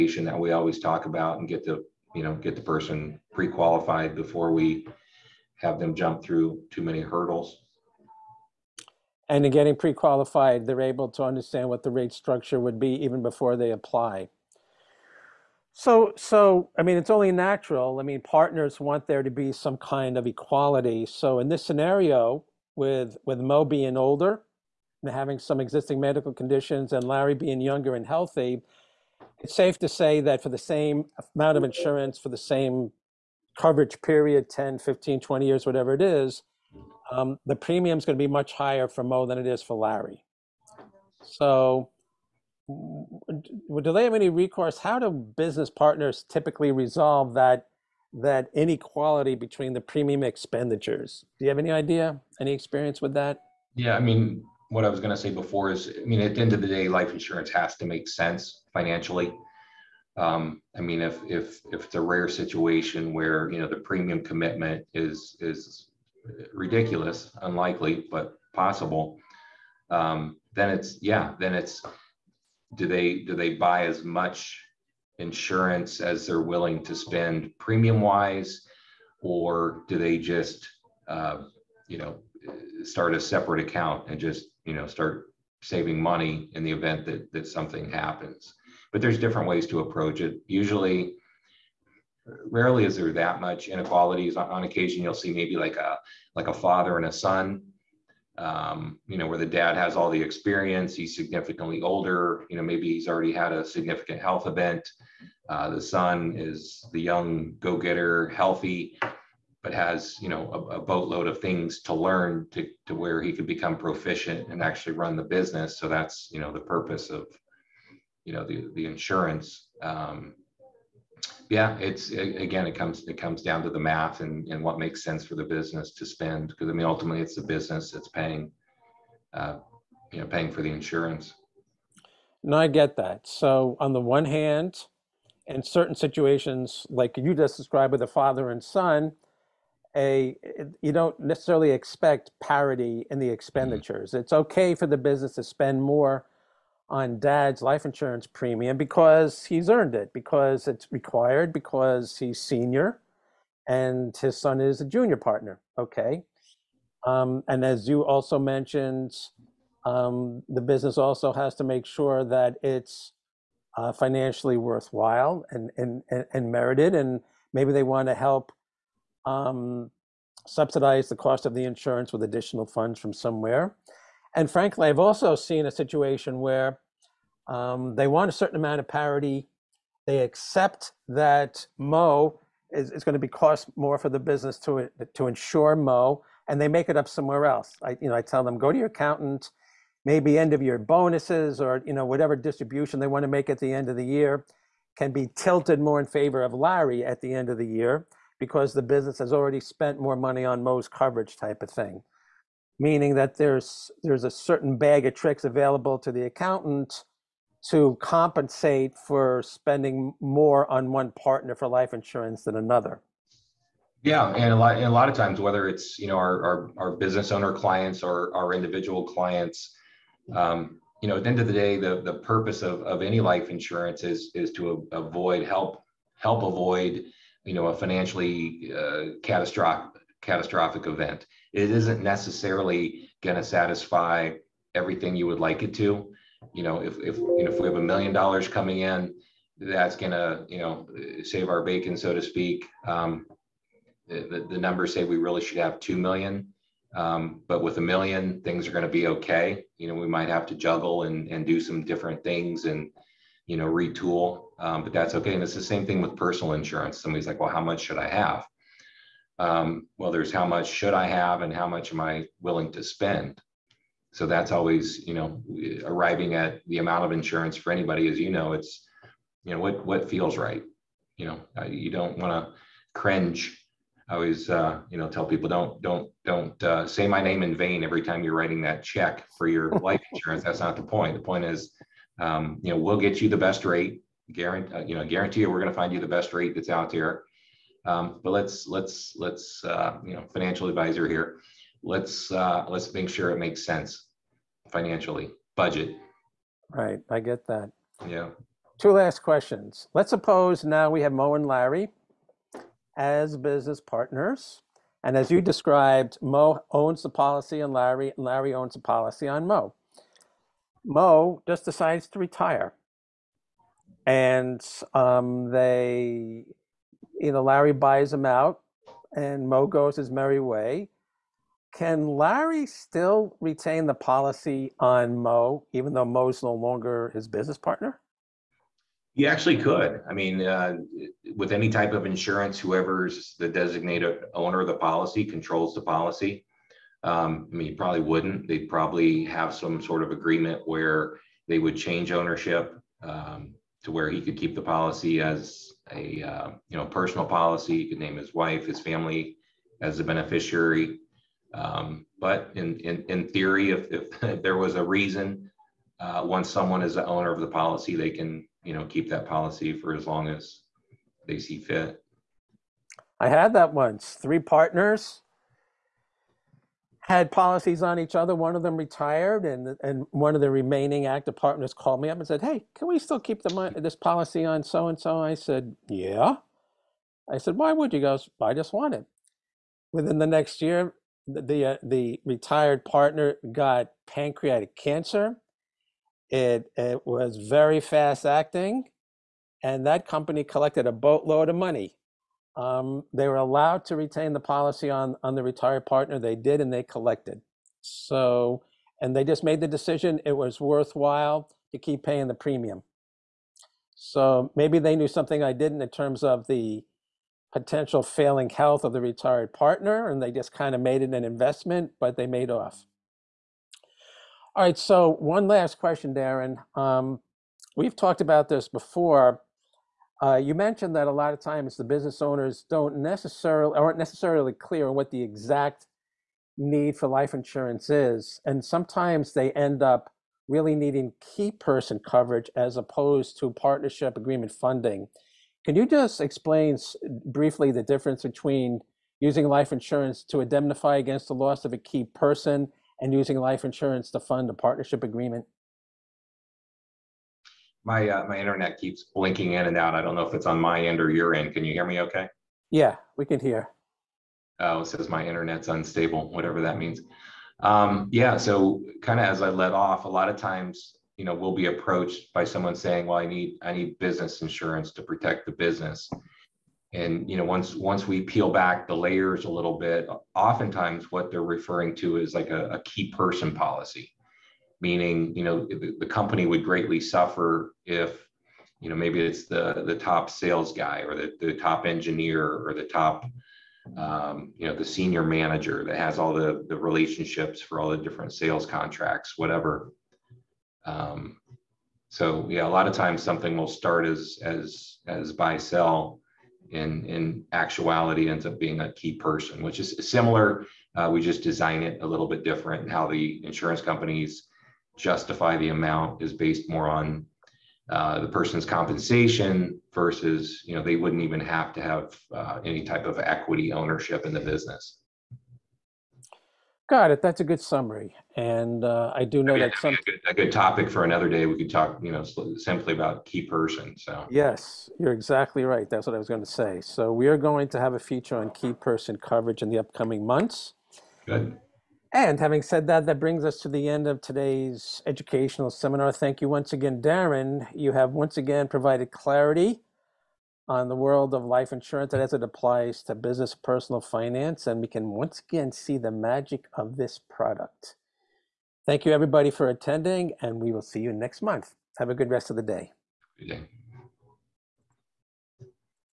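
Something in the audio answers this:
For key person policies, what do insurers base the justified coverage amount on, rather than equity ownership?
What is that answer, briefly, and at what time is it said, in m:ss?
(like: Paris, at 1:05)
compensation, at 8:28.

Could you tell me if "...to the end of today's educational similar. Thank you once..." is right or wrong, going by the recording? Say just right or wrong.
wrong.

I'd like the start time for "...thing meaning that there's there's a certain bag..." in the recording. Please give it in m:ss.
3:21.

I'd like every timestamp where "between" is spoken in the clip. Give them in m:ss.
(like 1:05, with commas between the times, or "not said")
0:49, 7:18.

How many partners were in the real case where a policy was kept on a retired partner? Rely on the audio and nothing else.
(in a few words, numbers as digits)
3.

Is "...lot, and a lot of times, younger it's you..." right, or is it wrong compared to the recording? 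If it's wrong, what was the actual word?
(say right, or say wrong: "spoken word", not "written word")
wrong: "whether", not "younger".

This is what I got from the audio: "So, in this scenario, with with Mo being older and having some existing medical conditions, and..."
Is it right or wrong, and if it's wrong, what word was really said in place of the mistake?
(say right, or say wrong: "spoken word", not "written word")
right.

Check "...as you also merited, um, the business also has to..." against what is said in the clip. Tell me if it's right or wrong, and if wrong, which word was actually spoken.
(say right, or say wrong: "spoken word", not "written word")
wrong: "mentioned", not "merited".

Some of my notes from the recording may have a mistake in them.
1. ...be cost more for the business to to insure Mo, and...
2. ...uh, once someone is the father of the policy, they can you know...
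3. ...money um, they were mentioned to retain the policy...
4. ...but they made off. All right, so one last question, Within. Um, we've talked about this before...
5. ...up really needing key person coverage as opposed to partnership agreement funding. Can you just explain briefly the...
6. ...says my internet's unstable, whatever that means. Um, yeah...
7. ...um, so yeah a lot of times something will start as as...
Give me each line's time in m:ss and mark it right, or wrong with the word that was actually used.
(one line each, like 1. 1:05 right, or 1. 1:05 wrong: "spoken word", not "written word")
1. 3:03 right
2. 5:55 wrong: "owner", not "father"
3. 6:31 wrong: "allowed", not "mentioned"
4. 6:51 wrong: "Darren", not "Within"
5. 7:09 right
6. 7:34 right
7. 8:10 right.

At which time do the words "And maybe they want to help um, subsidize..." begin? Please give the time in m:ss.
2:46.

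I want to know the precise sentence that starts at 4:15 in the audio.
And it's the same thing with personal insurance.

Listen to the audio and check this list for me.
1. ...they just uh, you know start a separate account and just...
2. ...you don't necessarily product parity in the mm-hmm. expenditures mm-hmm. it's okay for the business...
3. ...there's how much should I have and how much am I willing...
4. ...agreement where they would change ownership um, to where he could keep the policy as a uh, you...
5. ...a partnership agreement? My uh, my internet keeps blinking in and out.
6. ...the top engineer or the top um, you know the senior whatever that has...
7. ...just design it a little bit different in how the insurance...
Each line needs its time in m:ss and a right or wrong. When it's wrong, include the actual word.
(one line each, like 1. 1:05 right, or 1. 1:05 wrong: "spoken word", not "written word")
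1. 1:19 right
2. 2:20 wrong: "expect", not "product"
3. 4:20 right
4. 5:40 right
5. 7:24 right
6. 8:01 wrong: "manager", not "whatever"
7. 8:21 right.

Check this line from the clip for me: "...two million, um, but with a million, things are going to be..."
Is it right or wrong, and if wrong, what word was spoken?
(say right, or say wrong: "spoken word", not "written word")
right.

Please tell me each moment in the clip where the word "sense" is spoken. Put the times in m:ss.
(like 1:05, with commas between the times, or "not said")
0:58, 2:05, 4:53.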